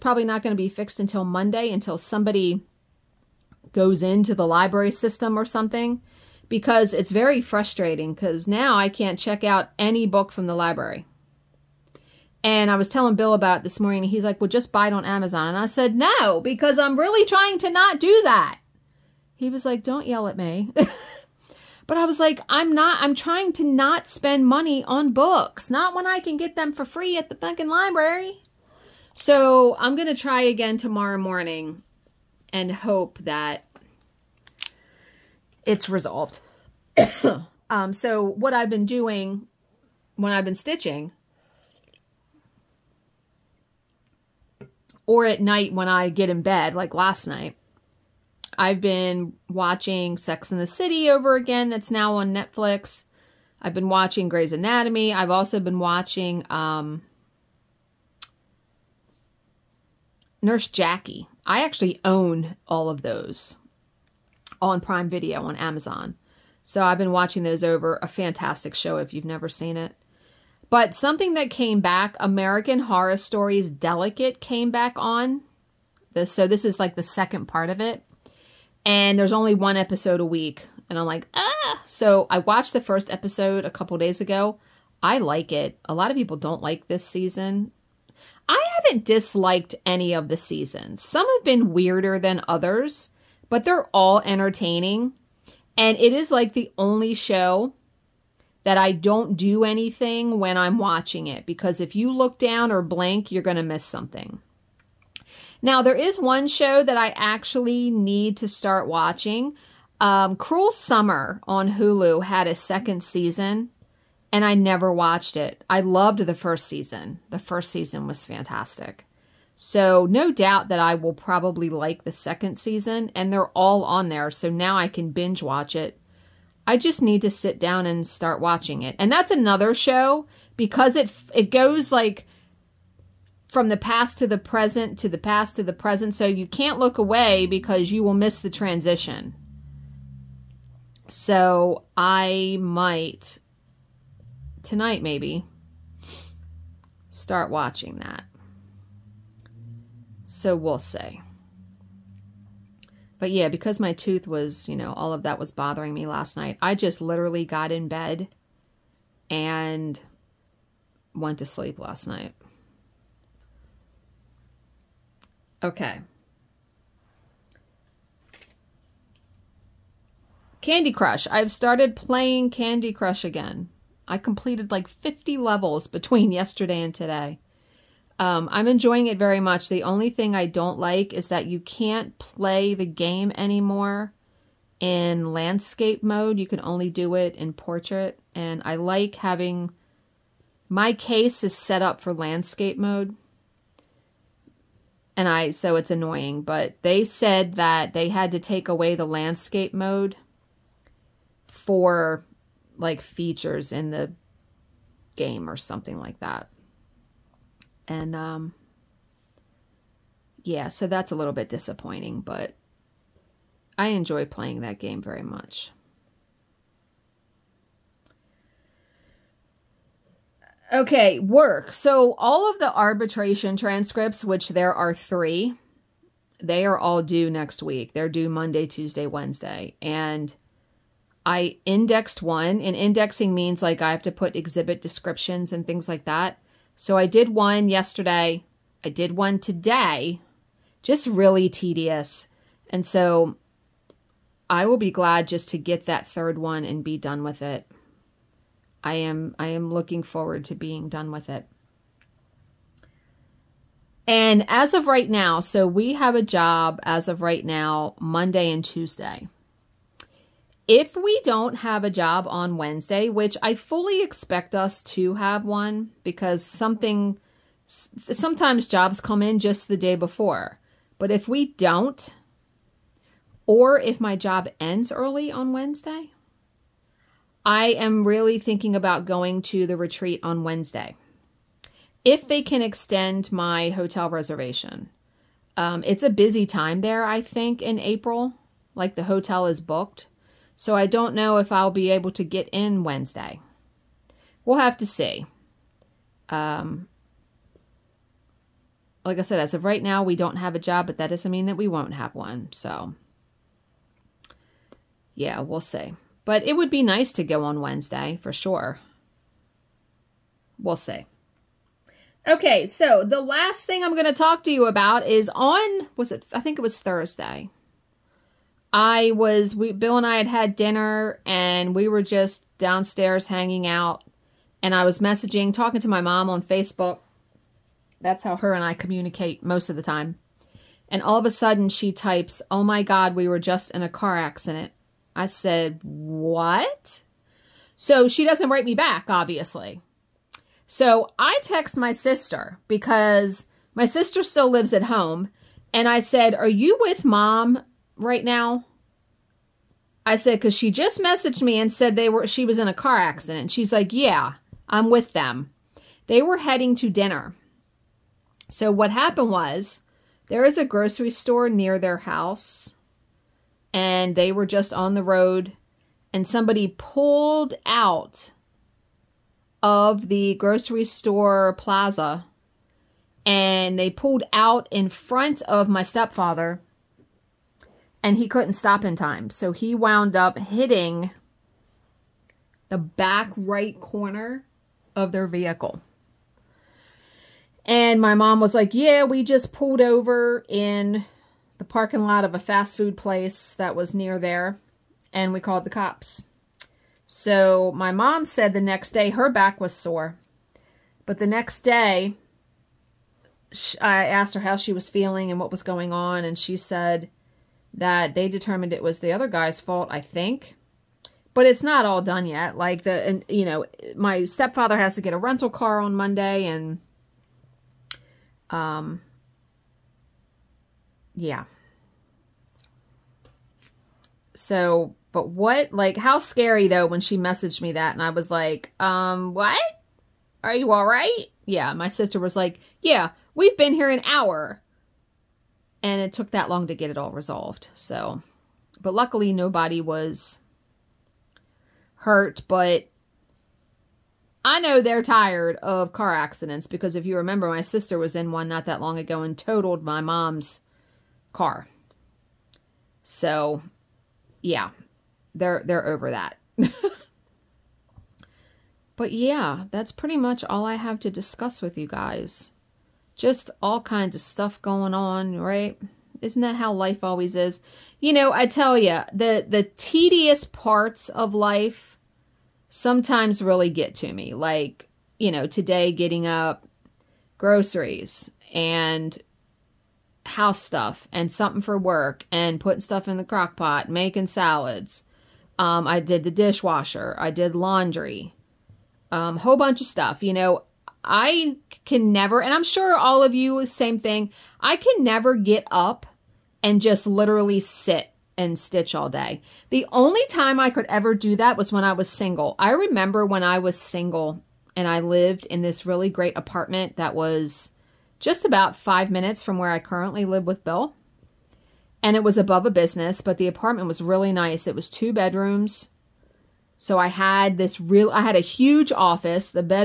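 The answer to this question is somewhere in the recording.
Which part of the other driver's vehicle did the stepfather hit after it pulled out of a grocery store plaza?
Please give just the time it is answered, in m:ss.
6:22.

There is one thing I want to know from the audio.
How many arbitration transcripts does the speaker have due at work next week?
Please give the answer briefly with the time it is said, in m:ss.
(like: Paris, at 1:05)
3, at 3:44.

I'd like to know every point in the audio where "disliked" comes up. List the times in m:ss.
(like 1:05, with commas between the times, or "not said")
1:29.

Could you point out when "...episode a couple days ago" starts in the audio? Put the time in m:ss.
1:23.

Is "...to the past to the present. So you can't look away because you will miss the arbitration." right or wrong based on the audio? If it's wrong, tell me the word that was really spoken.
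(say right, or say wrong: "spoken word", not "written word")
wrong: "transition", not "arbitration".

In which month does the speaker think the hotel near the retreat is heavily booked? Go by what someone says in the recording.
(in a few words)
April.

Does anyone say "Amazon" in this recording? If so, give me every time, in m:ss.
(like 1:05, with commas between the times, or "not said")
0:15, 1:05.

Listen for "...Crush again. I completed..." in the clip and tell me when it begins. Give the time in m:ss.
2:52.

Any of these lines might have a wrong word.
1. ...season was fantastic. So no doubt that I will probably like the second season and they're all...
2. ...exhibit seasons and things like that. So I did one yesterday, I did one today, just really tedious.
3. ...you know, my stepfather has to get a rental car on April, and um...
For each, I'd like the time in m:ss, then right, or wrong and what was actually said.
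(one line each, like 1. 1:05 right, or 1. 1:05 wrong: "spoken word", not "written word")
1. 1:57 right
2. 3:54 wrong: "descriptions", not "seasons"
3. 6:53 wrong: "Monday", not "April".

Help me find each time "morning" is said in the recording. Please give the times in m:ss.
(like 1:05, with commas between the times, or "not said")
0:13, 0:31.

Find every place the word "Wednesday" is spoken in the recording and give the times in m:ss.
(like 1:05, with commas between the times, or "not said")
3:49, 4:22, 4:35, 4:40, 4:52, 5:07.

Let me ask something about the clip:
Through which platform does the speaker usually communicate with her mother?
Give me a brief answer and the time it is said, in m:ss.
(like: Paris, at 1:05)
Facebook, at 5:26.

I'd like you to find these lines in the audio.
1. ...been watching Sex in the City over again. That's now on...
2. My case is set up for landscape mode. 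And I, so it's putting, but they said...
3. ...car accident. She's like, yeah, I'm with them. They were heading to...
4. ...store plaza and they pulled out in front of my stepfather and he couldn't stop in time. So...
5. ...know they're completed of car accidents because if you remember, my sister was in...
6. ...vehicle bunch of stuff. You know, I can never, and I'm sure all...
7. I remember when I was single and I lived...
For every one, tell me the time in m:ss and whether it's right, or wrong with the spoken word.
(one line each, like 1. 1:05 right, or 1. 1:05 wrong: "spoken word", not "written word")
1. 0:48 right
2. 3:10 wrong: "annoying", not "putting"
3. 5:52 right
4. 6:10 right
5. 7:24 wrong: "tired", not "completed"
6. 8:09 wrong: "whole", not "vehicle"
7. 8:22 right.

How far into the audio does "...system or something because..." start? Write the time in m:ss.
0:04.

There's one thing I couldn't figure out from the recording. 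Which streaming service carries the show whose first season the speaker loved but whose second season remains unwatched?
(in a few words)
Hulu.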